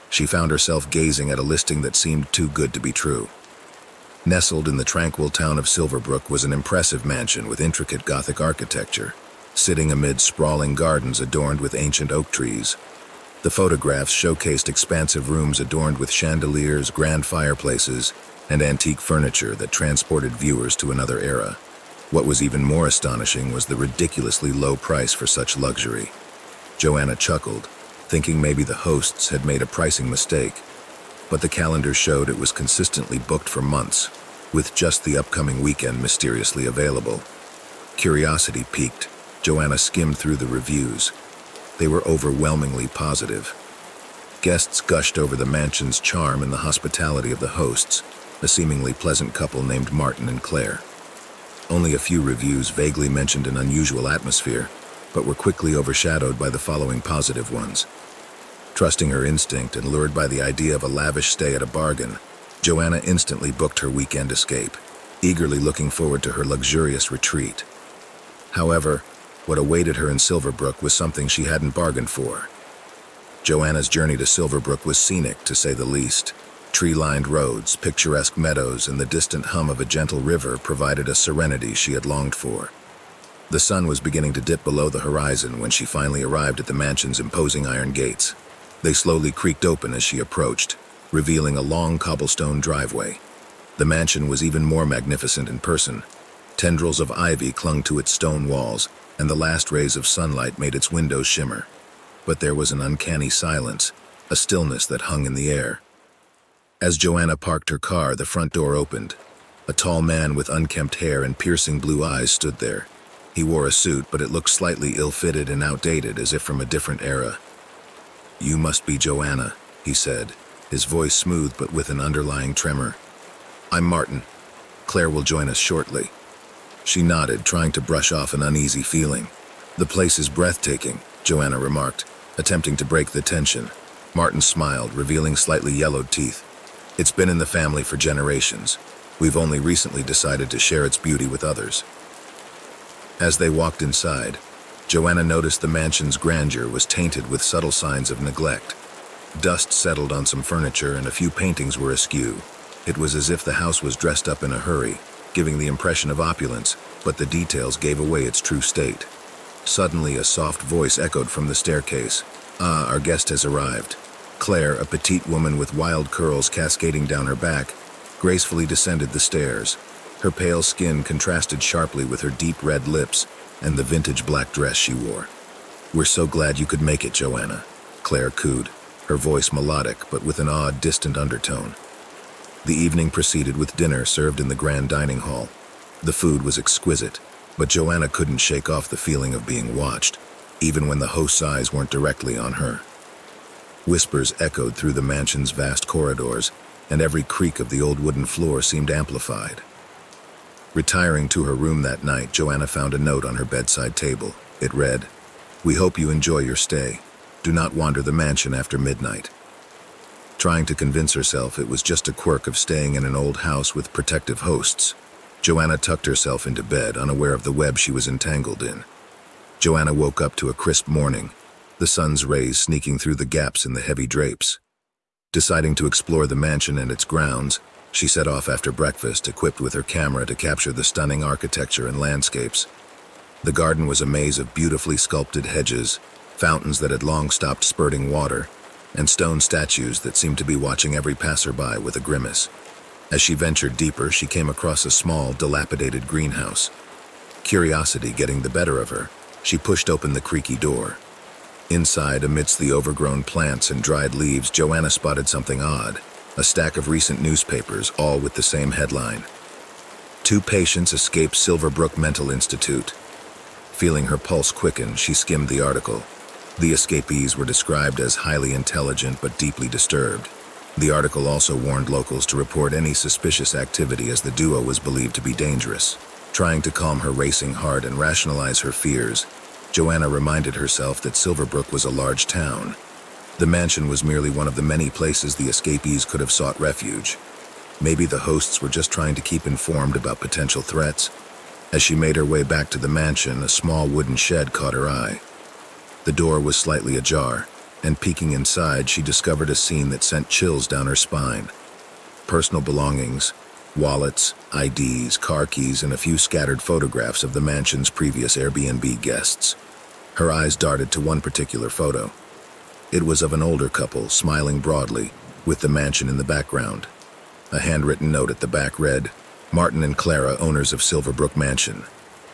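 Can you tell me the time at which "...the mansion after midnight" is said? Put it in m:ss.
3:28.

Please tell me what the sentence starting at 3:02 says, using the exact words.
The evening proceeded with dinner served in the grand dining hall.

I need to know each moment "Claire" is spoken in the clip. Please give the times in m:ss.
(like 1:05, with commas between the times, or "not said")
0:50, 2:04, 2:44, 2:58.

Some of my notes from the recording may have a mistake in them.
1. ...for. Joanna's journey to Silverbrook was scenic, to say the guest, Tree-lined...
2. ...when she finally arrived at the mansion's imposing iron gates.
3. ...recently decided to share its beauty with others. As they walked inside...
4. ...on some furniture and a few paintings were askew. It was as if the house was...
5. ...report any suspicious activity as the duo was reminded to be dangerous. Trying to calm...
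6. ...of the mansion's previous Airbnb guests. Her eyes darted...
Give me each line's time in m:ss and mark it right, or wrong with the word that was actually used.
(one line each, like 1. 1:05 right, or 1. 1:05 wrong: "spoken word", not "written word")
1. 1:12 wrong: "least", not "guest"
2. 1:25 right
3. 2:19 right
4. 2:30 right
5. 4:32 wrong: "believed", not "reminded"
6. 5:07 right.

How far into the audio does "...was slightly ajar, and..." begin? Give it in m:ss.
4:56.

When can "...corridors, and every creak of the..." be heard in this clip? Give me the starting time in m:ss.
3:15.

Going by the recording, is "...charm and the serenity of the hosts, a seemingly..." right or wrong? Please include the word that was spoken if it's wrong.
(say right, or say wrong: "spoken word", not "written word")
wrong: "hospitality", not "serenity".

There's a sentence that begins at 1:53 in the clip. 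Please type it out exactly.
He wore a suit, but it looked slightly ill-fitted and outdated, as if from a different era.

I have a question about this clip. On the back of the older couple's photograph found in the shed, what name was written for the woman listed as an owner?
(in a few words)
Clara.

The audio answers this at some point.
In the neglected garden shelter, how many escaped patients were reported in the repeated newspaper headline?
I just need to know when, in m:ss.
4:20.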